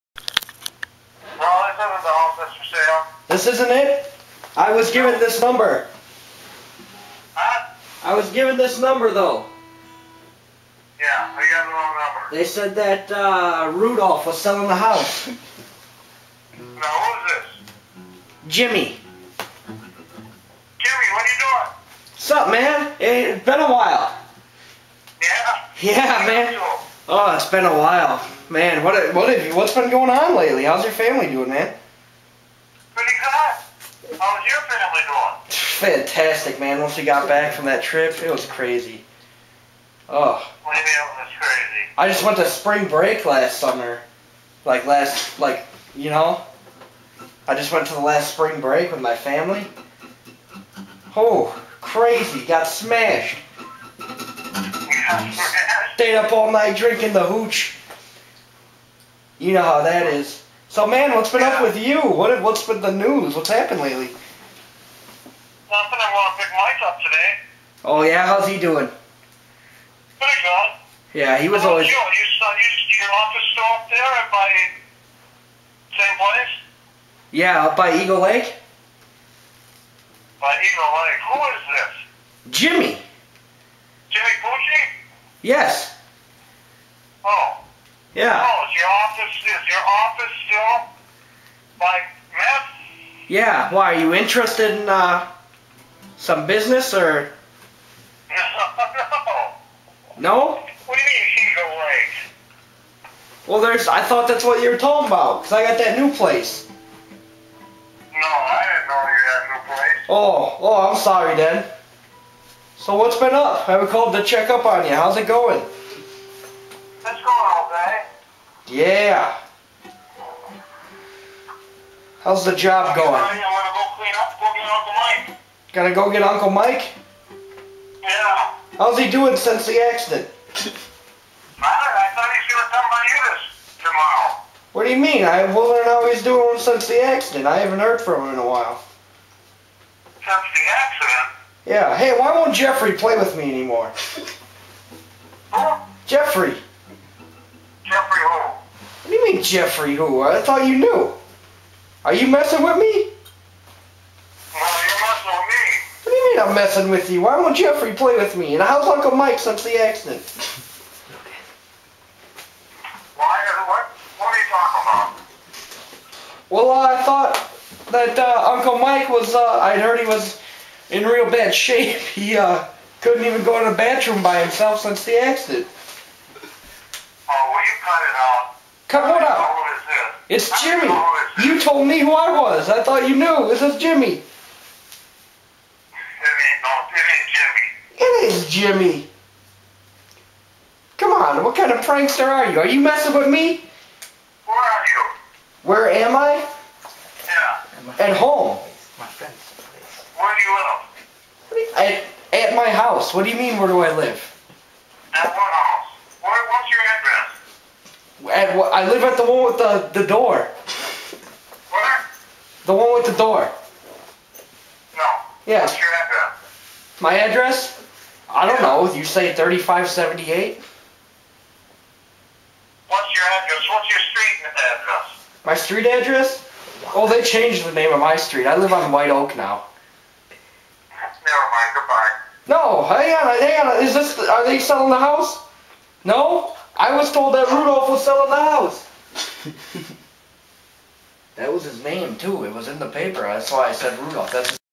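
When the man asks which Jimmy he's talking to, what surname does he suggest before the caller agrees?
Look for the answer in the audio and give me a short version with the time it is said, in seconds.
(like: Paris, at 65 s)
Pucci, at 84 s.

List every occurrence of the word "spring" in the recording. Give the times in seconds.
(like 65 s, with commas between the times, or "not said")
42 s, 48 s.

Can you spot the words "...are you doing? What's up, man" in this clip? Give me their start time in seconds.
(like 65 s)
21 s.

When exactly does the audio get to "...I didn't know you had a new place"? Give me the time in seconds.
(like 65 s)
108 s.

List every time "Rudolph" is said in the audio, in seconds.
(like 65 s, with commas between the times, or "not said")
13 s, 237 s, 243 s.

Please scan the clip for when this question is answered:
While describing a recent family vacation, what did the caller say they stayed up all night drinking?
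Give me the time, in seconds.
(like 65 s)
57 s.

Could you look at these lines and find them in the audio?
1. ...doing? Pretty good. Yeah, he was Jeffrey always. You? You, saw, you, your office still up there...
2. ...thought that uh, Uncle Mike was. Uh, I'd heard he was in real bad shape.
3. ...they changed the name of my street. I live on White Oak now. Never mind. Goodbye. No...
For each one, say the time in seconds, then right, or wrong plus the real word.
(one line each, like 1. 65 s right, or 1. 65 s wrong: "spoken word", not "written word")
1. 68 s wrong: "How", not "Jeffrey"
2. 167 s right
3. 227 s right.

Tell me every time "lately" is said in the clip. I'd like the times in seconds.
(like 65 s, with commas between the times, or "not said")
30 s, 63 s.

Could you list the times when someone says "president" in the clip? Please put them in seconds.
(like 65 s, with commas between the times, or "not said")
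not said.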